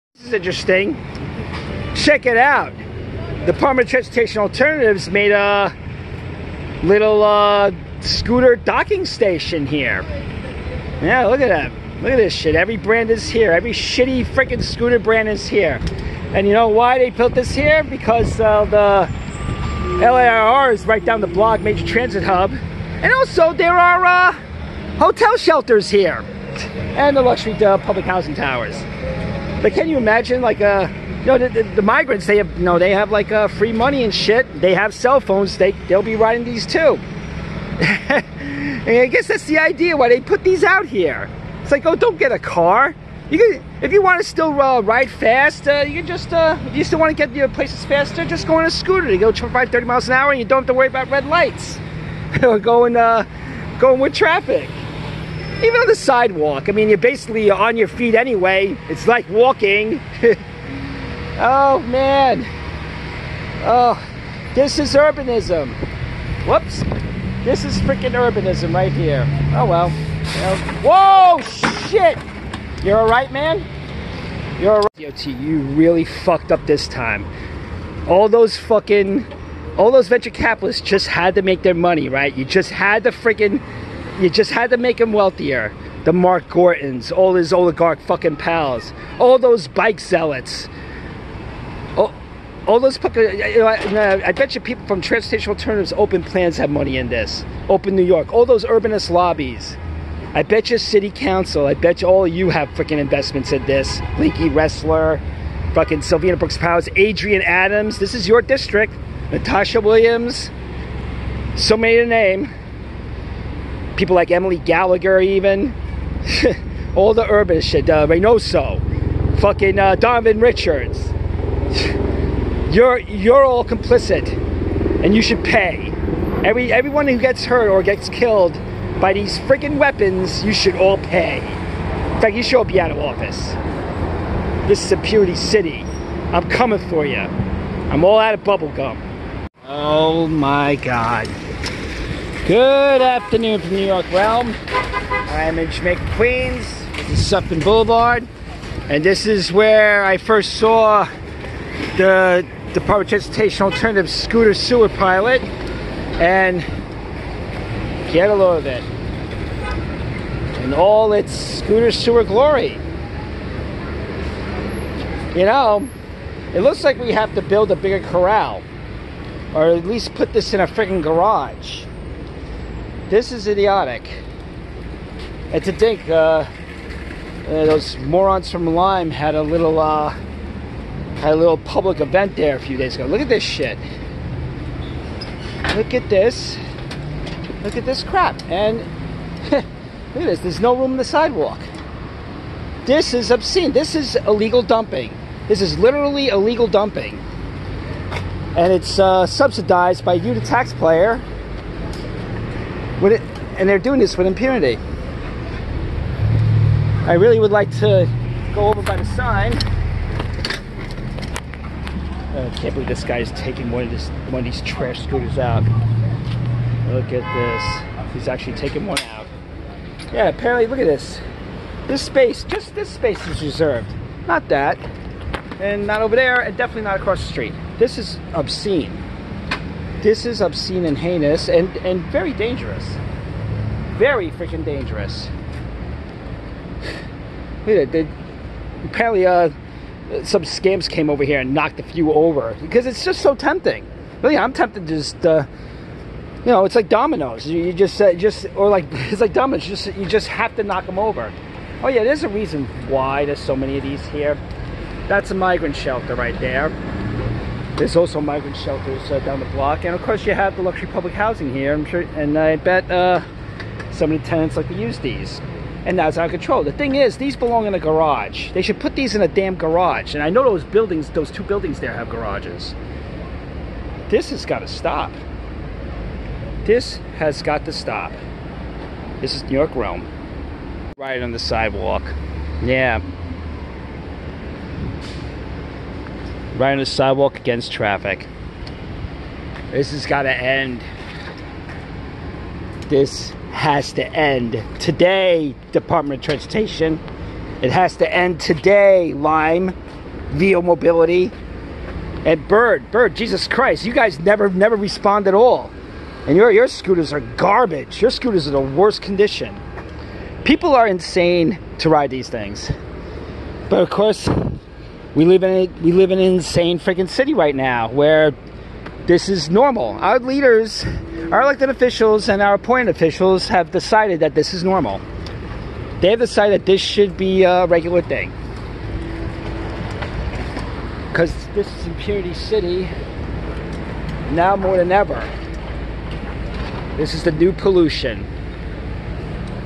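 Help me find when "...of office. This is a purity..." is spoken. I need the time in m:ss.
2:12.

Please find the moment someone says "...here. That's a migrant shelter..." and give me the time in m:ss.
4:14.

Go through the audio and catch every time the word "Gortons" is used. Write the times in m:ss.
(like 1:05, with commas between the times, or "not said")
1:26.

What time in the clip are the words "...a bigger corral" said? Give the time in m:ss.
2:47.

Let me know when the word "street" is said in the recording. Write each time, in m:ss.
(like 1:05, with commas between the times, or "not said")
3:47.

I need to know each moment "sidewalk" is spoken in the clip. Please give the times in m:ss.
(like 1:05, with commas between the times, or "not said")
0:55, 3:11, 4:41, 4:46.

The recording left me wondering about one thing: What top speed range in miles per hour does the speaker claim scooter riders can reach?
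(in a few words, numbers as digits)
25-30 mph.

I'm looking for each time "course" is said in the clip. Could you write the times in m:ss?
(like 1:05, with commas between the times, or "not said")
4:20, 5:13.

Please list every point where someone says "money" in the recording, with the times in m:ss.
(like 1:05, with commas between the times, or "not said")
0:33, 1:21, 1:36.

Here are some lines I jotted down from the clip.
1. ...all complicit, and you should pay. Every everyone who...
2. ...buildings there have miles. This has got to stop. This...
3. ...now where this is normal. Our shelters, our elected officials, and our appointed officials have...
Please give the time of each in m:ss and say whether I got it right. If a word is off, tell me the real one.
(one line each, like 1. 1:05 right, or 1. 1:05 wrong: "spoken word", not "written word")
1. 2:03 right
2. 4:31 wrong: "garages", not "miles"
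3. 5:17 wrong: "leaders", not "shelters".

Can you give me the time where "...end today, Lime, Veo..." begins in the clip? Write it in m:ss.
4:58.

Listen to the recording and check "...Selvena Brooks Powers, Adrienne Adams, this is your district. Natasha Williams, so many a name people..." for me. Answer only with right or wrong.
right.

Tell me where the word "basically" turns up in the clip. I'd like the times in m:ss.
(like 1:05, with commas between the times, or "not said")
0:56.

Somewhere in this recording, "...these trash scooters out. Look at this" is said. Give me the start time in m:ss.
3:34.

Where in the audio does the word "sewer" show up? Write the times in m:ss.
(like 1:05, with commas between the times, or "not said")
2:34, 2:41.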